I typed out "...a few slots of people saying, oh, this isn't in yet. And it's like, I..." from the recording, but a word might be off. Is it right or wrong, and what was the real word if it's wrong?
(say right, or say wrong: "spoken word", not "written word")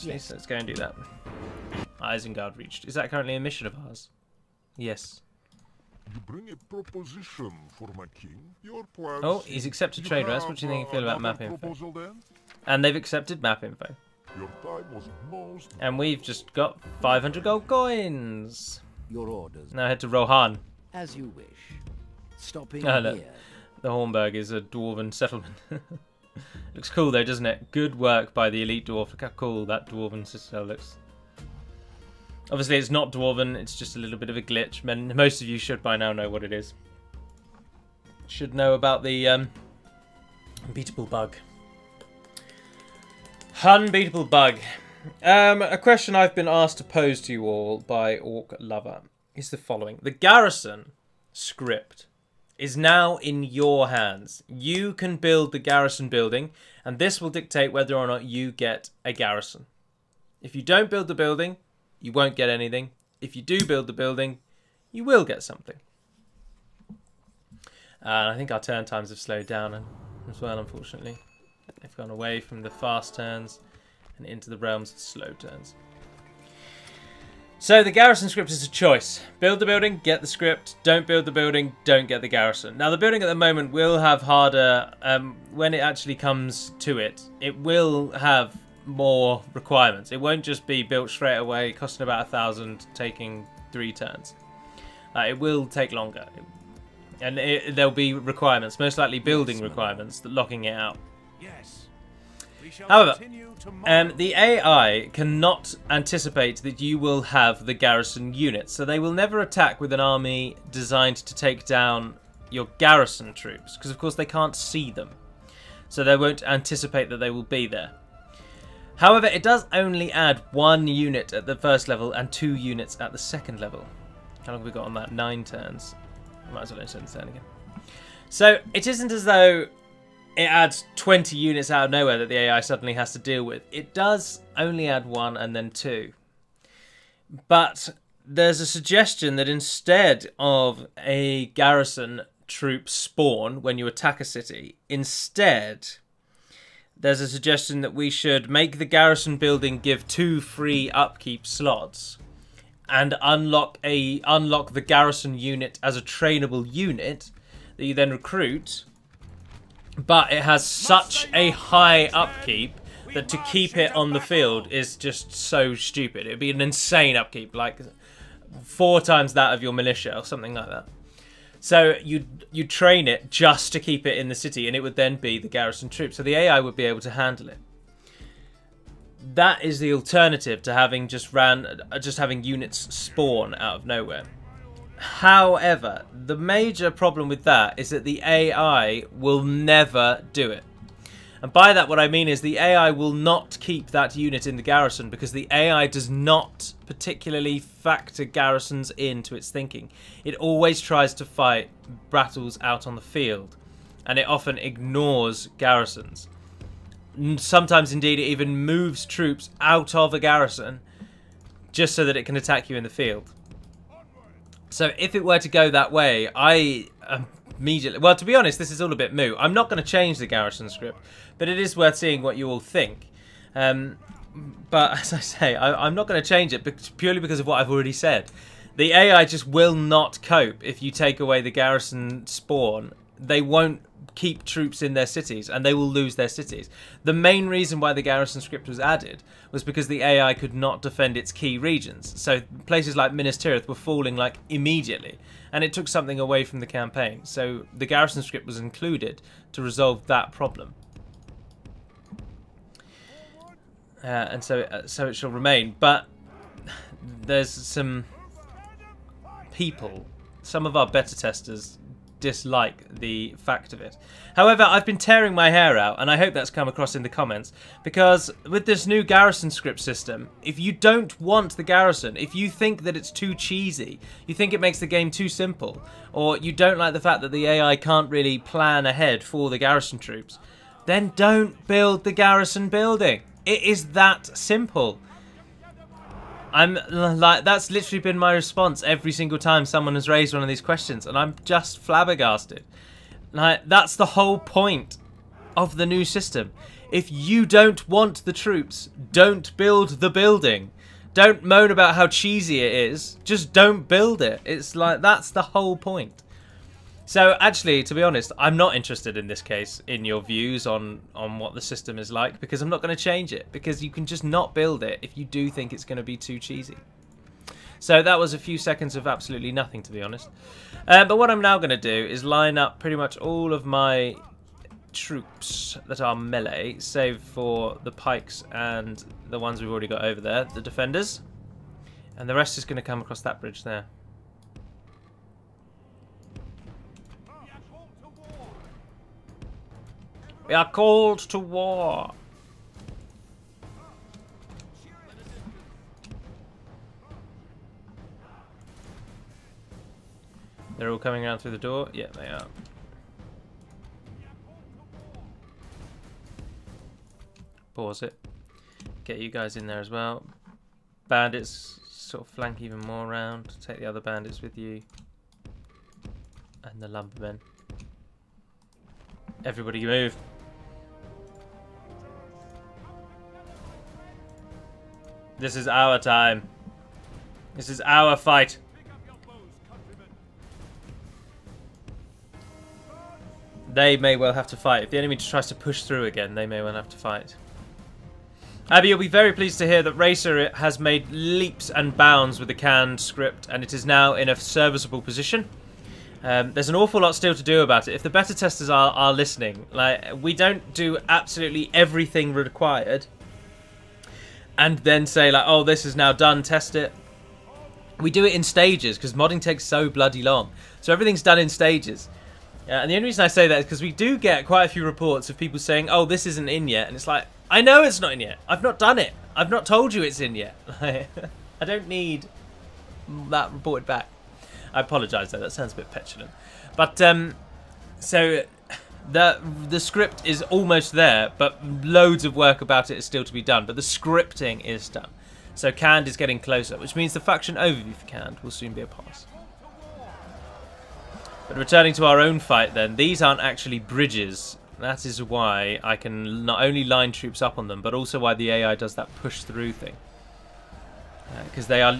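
wrong: "reports", not "slots".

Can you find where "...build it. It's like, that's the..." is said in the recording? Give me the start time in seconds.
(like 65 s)
303 s.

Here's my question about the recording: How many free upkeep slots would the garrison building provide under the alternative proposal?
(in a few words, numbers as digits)
2.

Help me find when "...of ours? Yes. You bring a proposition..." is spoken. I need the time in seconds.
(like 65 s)
3 s.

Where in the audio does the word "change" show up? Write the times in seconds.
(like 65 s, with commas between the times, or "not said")
219 s, 226 s, 313 s.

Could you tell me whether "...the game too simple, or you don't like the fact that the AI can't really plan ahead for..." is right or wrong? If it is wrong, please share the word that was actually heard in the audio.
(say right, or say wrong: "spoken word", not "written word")
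right.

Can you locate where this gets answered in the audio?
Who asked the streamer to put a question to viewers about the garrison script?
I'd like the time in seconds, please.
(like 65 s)
48 s.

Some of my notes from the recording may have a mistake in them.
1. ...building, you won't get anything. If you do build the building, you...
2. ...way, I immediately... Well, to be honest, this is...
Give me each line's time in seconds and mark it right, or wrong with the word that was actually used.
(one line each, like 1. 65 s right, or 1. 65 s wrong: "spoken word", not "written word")
1. 61 s right
2. 215 s right.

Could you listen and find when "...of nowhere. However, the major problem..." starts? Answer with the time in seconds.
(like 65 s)
183 s.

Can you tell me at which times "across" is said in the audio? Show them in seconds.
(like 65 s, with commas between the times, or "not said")
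266 s, 333 s.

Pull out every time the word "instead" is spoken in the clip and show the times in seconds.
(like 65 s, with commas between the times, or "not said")
139 s, 144 s.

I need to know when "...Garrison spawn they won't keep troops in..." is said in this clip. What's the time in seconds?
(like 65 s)
231 s.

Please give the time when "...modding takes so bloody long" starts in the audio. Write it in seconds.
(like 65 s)
409 s.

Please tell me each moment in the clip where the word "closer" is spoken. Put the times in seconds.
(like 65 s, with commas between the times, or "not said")
436 s.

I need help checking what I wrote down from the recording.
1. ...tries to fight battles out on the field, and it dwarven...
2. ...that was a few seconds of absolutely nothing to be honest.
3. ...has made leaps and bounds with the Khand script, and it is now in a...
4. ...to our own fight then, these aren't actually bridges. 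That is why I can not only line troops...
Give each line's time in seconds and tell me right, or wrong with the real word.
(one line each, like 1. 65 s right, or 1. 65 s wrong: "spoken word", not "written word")
1. 200 s wrong: "often", not "dwarven"
2. 318 s right
3. 390 s right
4. 441 s right.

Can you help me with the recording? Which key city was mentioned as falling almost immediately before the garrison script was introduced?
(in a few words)
Minas Tirith.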